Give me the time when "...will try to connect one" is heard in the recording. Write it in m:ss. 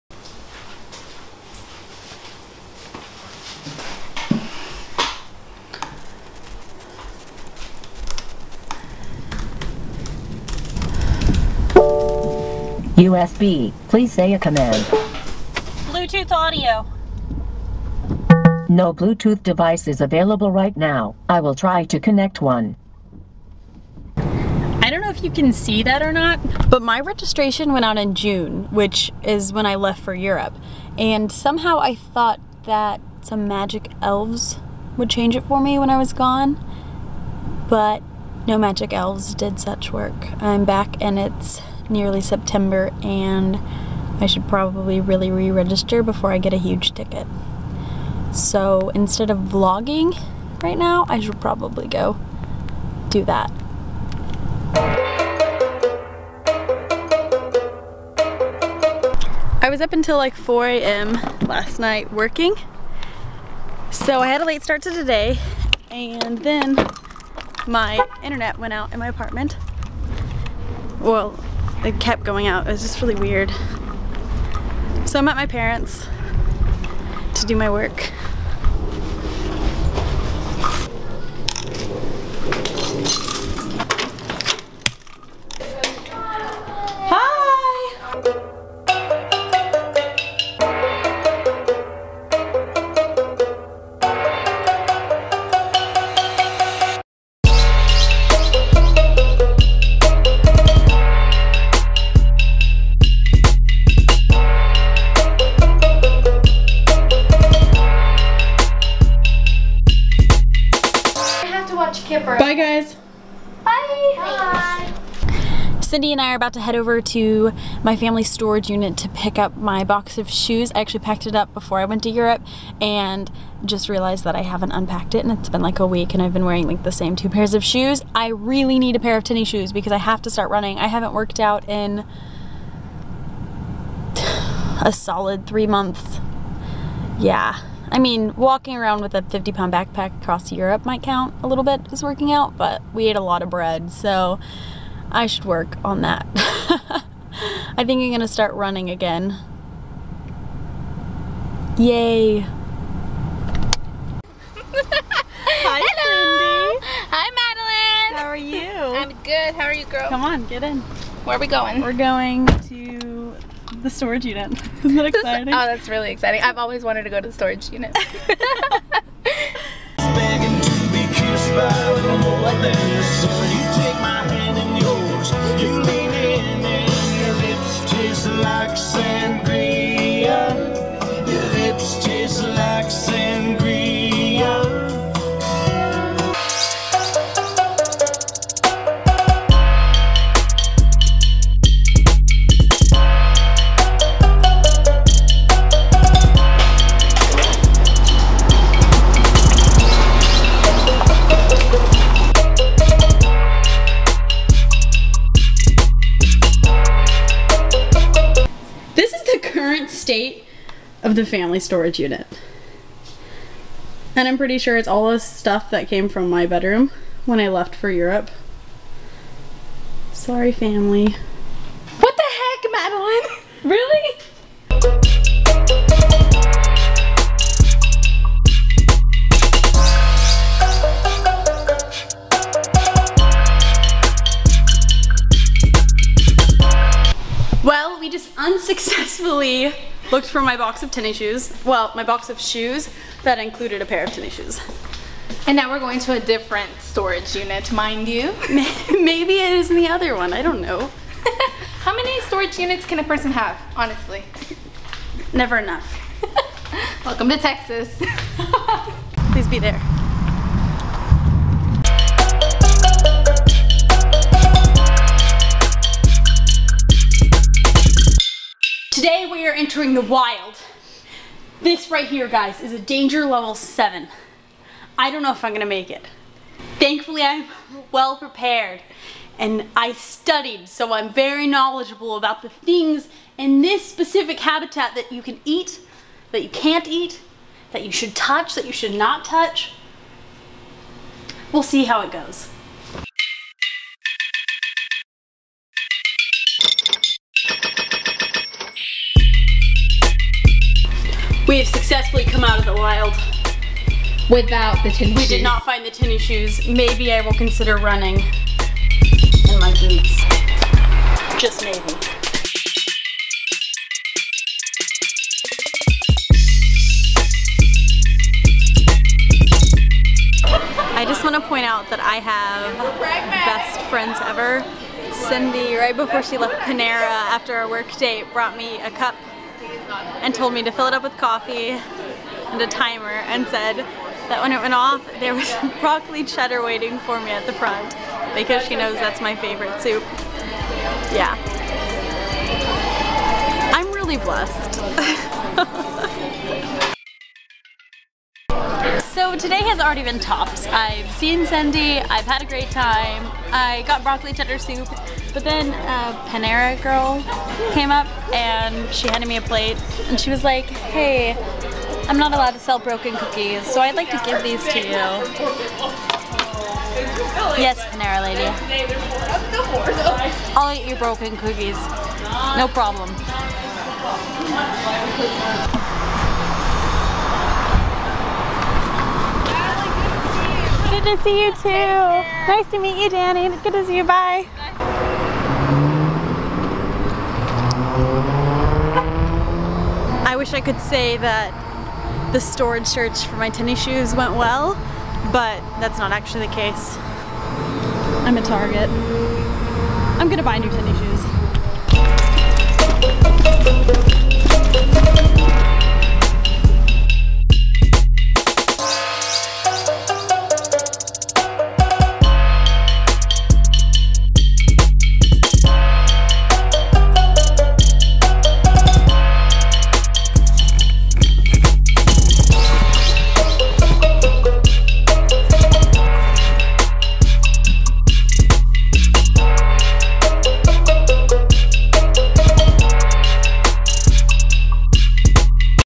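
0:21.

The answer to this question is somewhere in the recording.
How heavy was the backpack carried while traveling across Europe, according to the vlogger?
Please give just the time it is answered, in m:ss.
2:19.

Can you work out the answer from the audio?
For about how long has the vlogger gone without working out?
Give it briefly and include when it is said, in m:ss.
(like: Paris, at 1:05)
three months, at 2:15.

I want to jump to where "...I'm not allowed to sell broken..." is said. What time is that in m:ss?
6:02.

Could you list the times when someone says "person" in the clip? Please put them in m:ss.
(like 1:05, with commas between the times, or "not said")
4:13.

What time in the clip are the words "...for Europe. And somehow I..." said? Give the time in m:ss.
0:30.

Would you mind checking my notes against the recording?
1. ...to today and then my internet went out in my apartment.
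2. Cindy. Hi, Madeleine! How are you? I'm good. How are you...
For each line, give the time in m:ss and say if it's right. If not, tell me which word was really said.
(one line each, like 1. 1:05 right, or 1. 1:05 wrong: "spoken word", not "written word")
1. 1:04 right
2. 2:36 right.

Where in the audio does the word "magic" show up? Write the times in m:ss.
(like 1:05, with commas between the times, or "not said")
0:33, 0:38.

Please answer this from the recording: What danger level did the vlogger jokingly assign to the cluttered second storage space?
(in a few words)
7.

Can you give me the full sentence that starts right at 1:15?
So I'm at my parents to do my work.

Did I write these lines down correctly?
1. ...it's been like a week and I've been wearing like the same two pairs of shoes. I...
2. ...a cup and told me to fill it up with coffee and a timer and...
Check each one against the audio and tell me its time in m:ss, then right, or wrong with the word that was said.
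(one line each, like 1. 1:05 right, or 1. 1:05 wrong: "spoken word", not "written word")
1. 2:05 right
2. 5:28 right.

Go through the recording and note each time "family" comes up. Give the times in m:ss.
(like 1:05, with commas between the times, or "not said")
1:57, 3:31, 3:40.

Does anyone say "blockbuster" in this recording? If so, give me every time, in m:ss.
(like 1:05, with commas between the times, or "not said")
not said.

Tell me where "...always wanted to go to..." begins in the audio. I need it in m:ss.
2:46.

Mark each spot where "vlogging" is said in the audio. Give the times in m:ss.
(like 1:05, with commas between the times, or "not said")
0:49.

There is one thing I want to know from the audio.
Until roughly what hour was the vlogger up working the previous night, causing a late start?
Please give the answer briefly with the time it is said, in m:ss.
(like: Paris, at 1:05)
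4 a.m., at 1:00.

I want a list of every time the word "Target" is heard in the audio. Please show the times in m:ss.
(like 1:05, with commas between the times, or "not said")
6:38.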